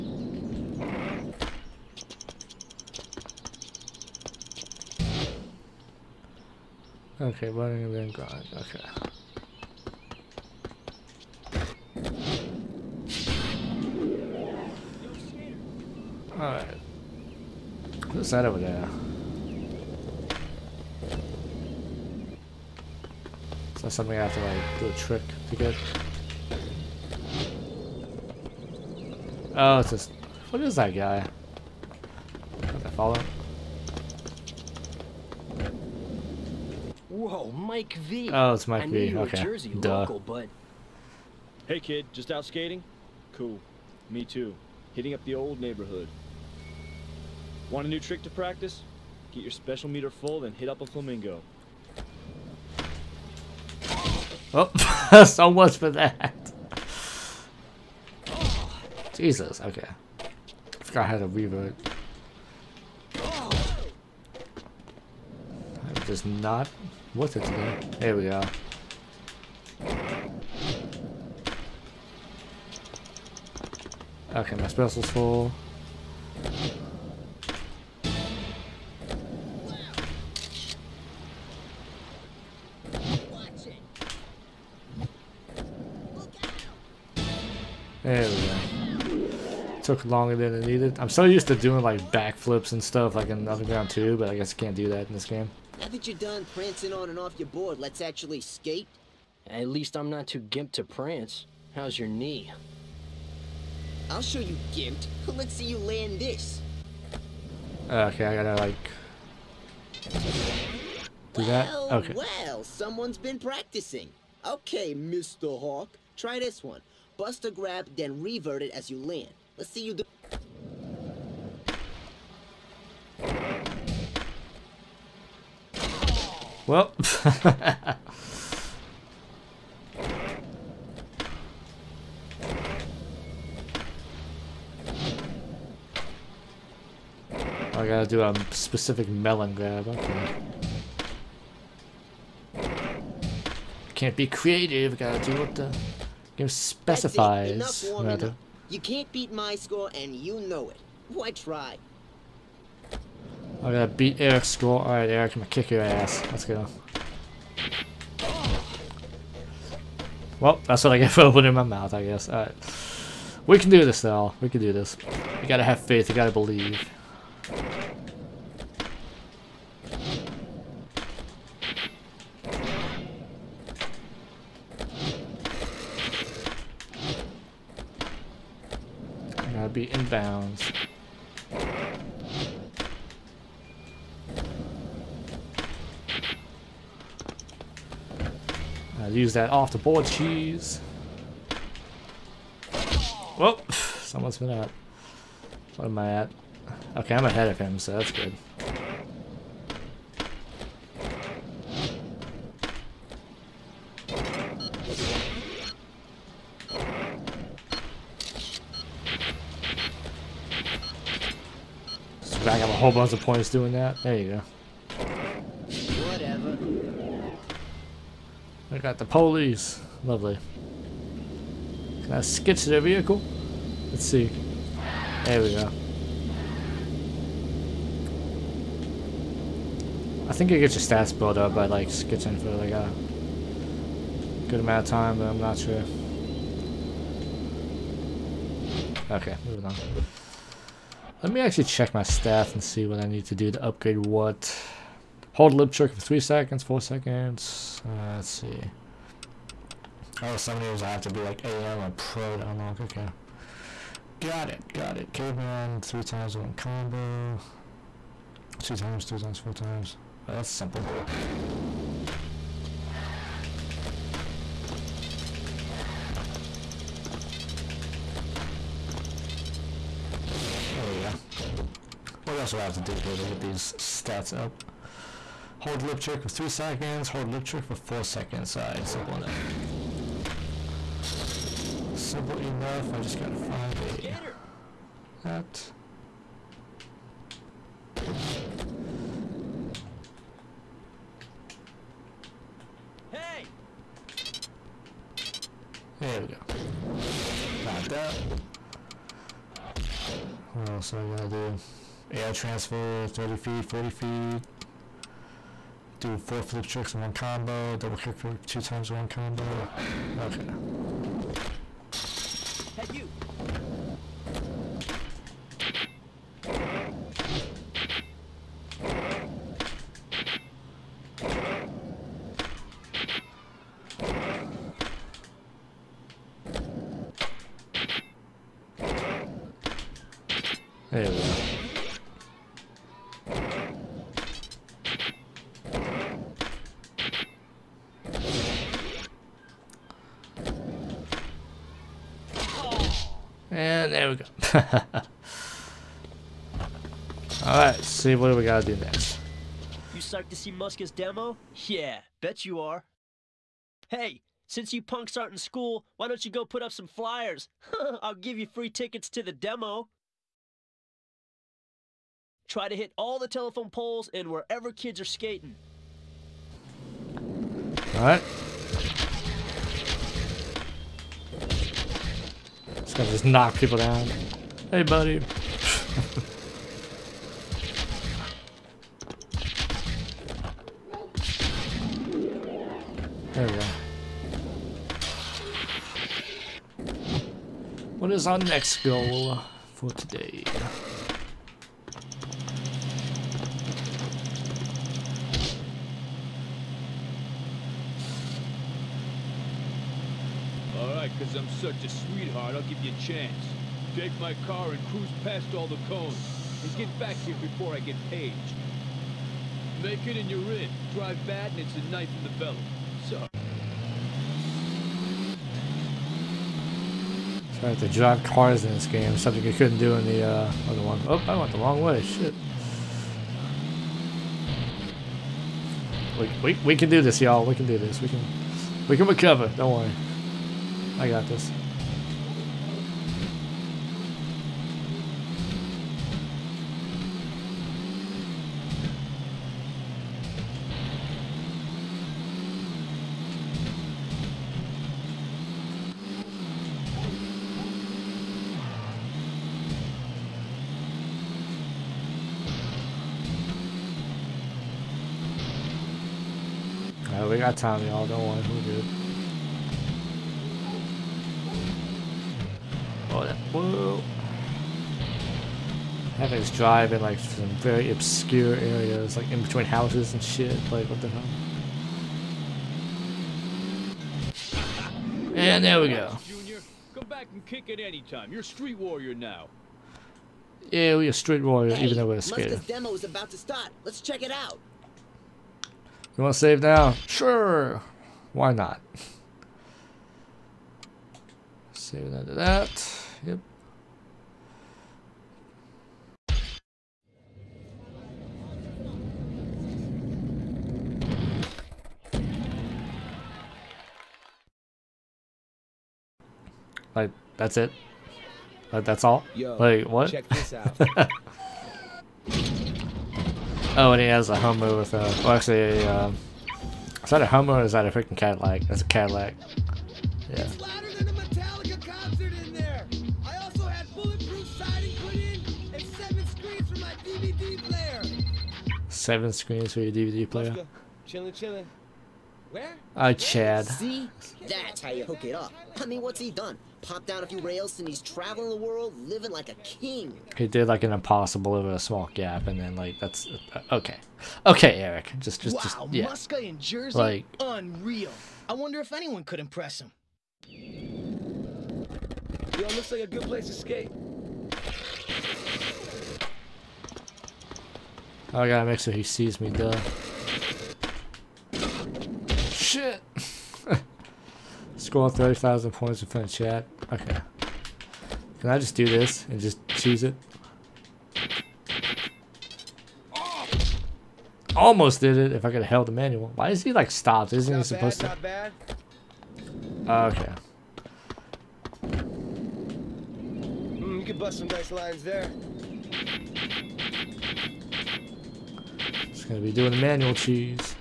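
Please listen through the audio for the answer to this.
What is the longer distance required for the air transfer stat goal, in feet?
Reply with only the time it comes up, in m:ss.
5:03.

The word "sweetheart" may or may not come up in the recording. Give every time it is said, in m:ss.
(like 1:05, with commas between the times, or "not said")
6:41.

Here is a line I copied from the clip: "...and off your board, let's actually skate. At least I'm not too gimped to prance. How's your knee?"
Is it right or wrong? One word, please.
right.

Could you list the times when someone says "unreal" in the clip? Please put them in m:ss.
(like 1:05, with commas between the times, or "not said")
9:07.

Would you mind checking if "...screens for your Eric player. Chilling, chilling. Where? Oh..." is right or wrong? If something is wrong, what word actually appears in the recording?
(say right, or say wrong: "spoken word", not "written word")
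wrong: "DVD", not "Eric".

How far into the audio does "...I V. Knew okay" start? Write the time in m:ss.
0:38.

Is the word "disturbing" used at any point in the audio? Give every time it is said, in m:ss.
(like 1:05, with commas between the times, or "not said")
not said.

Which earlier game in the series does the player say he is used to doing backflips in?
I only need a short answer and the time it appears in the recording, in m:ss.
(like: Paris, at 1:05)
Underground 2, at 1:33.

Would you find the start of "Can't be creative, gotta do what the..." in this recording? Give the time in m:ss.
2:23.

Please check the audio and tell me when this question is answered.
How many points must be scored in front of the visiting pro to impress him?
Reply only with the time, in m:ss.
9:25.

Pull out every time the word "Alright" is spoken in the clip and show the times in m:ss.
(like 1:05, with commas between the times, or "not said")
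2:34, 2:42, 4:38, 5:47.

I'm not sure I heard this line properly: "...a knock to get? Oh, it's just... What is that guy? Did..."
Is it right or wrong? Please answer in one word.
wrong.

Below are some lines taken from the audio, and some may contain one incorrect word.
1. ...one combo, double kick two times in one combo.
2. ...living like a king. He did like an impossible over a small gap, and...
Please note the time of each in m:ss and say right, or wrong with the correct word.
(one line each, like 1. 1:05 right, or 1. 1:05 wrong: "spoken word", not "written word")
1. 5:07 right
2. 8:59 right.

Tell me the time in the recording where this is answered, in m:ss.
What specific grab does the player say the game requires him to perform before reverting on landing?
2:19.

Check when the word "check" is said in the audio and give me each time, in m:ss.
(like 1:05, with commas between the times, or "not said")
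4:01, 8:04, 8:30.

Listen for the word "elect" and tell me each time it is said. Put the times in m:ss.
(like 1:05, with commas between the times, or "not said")
not said.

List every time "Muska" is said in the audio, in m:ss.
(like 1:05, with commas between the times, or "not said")
5:50, 9:06.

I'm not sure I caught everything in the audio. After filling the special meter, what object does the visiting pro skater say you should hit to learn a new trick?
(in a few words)
a flamingo.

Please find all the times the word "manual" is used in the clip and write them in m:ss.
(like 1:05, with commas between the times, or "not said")
9:35, 9:49.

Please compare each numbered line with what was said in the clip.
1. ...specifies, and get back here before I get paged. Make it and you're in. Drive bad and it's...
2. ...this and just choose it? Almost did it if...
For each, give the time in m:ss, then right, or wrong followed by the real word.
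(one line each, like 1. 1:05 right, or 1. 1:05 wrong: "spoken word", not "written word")
1. 6:45 wrong: "cones", not "specifies"
2. 9:28 right.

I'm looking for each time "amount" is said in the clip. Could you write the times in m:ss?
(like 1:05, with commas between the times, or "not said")
3:54.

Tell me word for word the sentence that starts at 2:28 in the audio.
You can't beat my score, and you know it.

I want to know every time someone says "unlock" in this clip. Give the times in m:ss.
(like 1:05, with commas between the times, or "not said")
4:12.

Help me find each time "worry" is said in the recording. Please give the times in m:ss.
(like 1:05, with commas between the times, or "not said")
7:09, 7:38.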